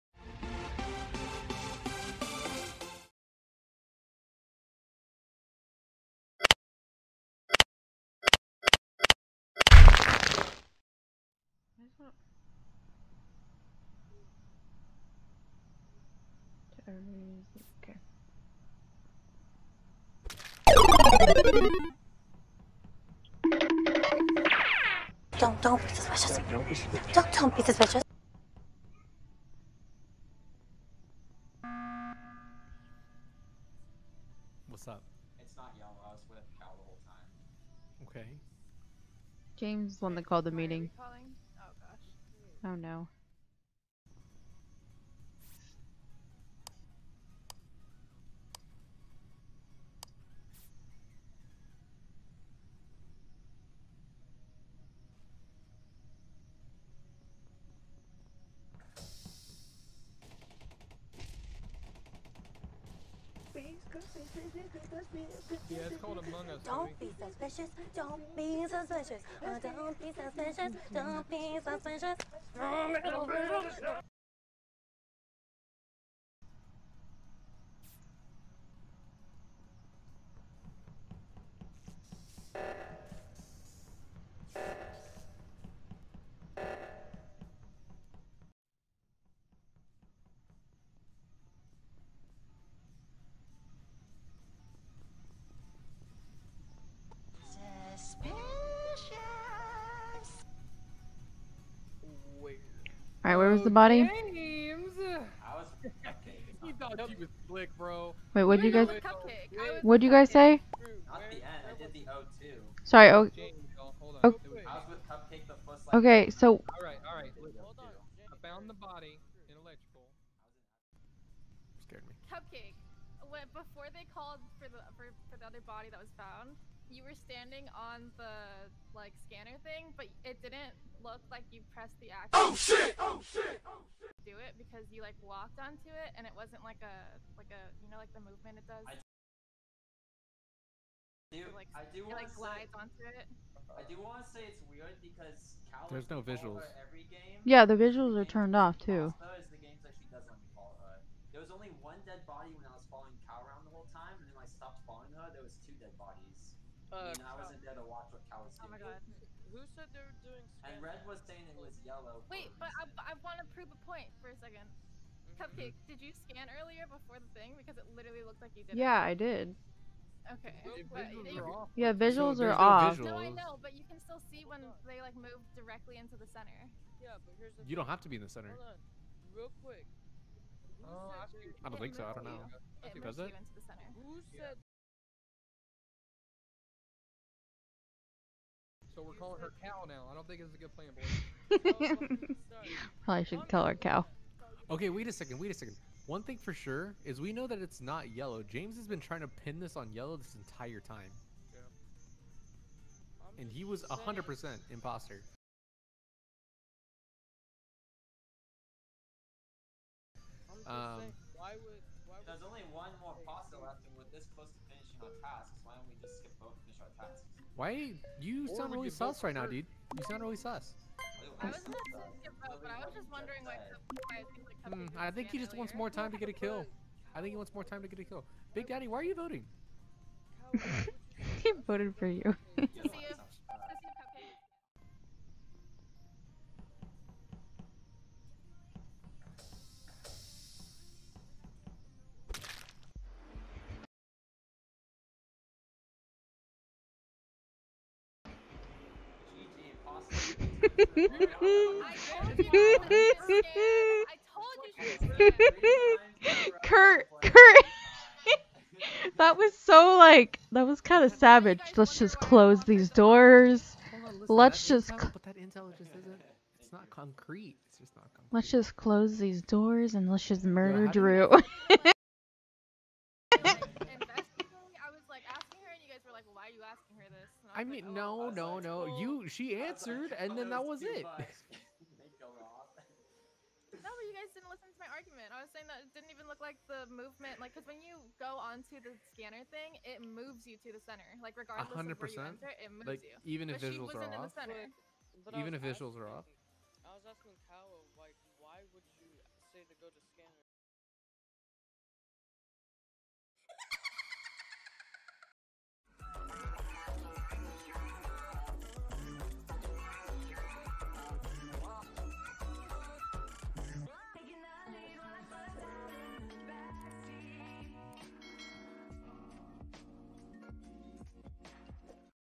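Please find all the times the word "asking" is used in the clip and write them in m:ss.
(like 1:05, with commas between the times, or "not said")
4:36, 4:57.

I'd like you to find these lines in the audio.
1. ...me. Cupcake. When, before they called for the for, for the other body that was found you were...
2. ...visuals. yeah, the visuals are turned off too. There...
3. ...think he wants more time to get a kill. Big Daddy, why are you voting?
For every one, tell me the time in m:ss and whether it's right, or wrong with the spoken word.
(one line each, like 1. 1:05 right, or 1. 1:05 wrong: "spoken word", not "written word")
1. 2:02 right
2. 2:26 right
3. 3:47 right.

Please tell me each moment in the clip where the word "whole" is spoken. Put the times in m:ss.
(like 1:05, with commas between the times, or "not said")
0:36, 2:33.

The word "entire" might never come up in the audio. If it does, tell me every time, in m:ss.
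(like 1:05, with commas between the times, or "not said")
3:20.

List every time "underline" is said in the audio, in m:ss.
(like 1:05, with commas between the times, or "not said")
not said.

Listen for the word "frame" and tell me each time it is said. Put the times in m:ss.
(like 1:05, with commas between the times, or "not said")
not said.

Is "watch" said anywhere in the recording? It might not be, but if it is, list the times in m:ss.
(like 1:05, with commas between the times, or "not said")
2:37.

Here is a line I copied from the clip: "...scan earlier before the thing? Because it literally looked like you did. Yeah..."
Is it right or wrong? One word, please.
right.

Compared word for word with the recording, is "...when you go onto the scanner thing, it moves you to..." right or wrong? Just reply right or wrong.
right.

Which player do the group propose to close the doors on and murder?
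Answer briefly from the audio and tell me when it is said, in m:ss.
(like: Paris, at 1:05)
Drew, at 4:30.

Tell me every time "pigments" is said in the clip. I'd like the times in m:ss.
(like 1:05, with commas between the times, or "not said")
not said.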